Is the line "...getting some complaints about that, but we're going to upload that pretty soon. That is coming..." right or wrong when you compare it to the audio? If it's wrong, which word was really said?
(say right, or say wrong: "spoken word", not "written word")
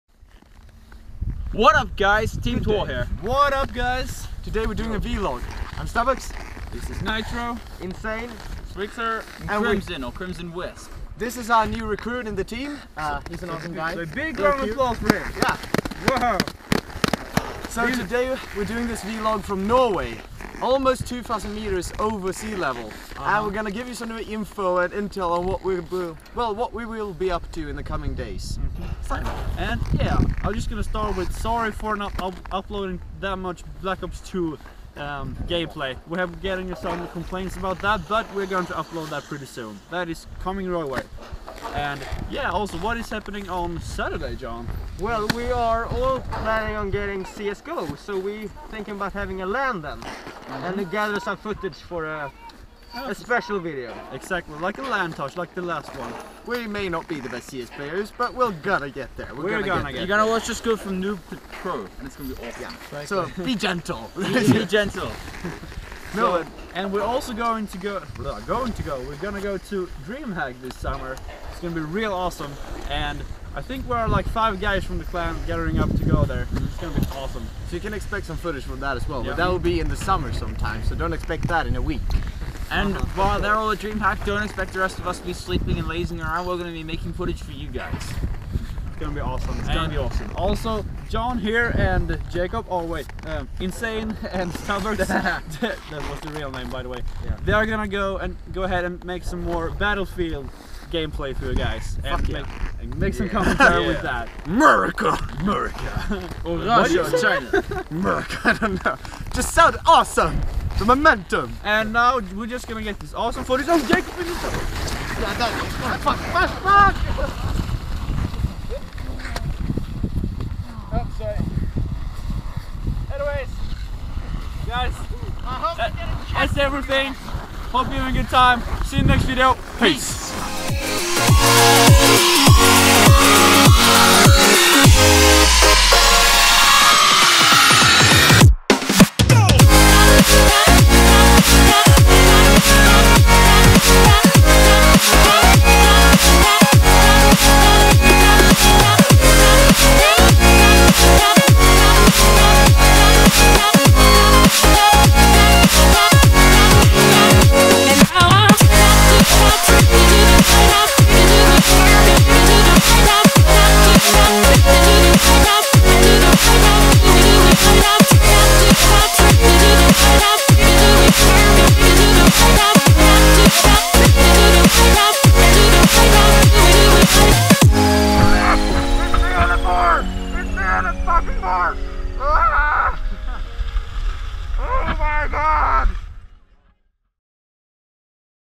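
right.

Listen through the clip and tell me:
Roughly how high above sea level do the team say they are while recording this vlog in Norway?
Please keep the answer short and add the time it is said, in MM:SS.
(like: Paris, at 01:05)
2,000 meters, at 00:21.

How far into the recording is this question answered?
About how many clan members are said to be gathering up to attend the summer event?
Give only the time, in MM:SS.
01:14.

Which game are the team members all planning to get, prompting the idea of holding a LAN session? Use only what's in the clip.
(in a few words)
CSGO.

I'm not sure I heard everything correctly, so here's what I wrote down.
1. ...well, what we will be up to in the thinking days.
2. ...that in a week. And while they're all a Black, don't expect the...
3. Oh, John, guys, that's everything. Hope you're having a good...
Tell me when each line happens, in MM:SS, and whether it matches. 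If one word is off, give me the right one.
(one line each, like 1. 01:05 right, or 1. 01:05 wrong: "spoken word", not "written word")
1. 00:26 wrong: "coming", not "thinking"
2. 01:21 wrong: "DreamHack", not "Black"
3. 02:00 wrong: "Anyways", not "John".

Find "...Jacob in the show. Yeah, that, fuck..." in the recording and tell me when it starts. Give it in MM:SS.
01:53.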